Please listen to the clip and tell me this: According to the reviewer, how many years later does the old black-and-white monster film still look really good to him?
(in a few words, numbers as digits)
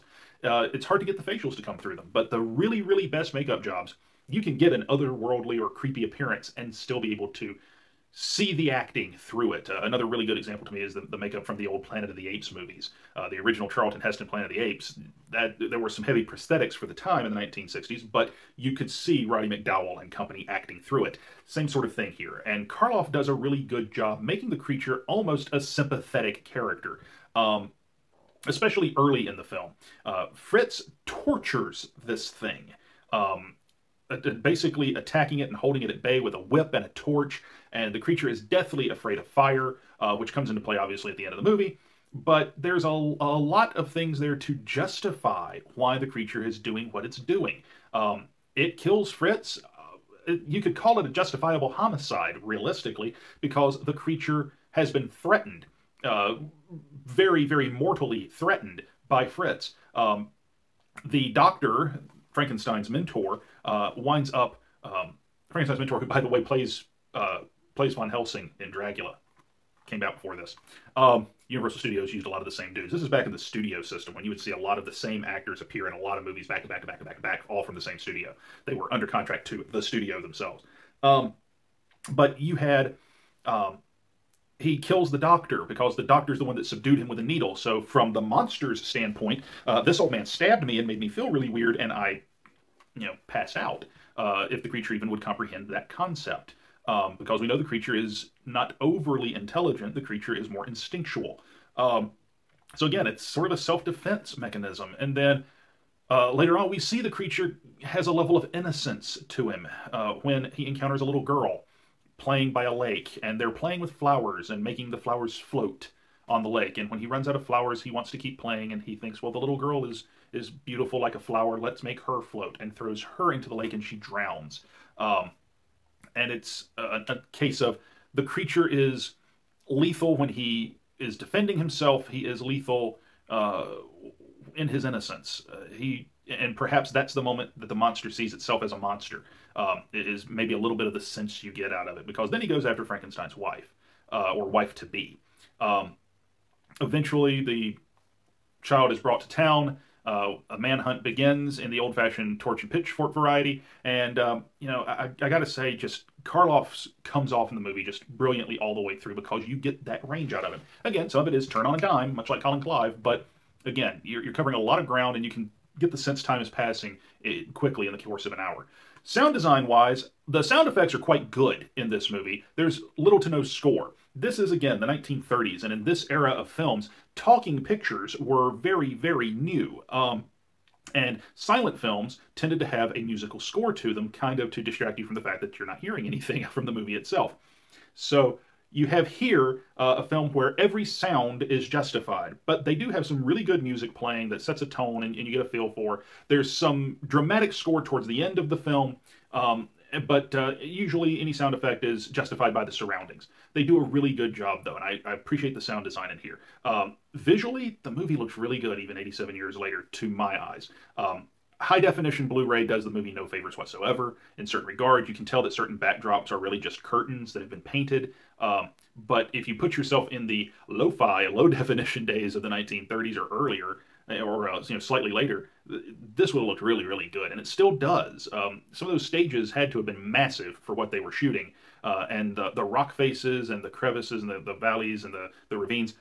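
87.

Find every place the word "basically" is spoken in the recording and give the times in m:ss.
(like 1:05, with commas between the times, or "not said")
0:34.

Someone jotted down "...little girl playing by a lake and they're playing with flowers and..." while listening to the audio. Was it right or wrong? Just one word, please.
right.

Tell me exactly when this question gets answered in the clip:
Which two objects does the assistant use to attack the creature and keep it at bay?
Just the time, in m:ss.
0:36.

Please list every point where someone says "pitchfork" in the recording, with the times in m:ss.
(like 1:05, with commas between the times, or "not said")
2:32.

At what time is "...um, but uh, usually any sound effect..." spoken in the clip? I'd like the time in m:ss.
3:19.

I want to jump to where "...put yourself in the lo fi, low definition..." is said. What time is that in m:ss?
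3:39.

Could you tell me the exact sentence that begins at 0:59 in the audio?
Um, the doctor, Frankenstein's mentor, uh, winds up.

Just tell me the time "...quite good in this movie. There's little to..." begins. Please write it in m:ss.
2:50.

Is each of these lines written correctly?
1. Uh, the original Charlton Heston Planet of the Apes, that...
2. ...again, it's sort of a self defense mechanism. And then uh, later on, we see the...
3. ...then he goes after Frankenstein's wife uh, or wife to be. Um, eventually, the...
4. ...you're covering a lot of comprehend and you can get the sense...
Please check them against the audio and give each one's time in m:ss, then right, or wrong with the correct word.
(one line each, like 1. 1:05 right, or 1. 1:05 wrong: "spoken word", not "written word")
1. 0:13 right
2. 1:42 right
3. 2:22 right
4. 2:44 wrong: "ground", not "comprehend".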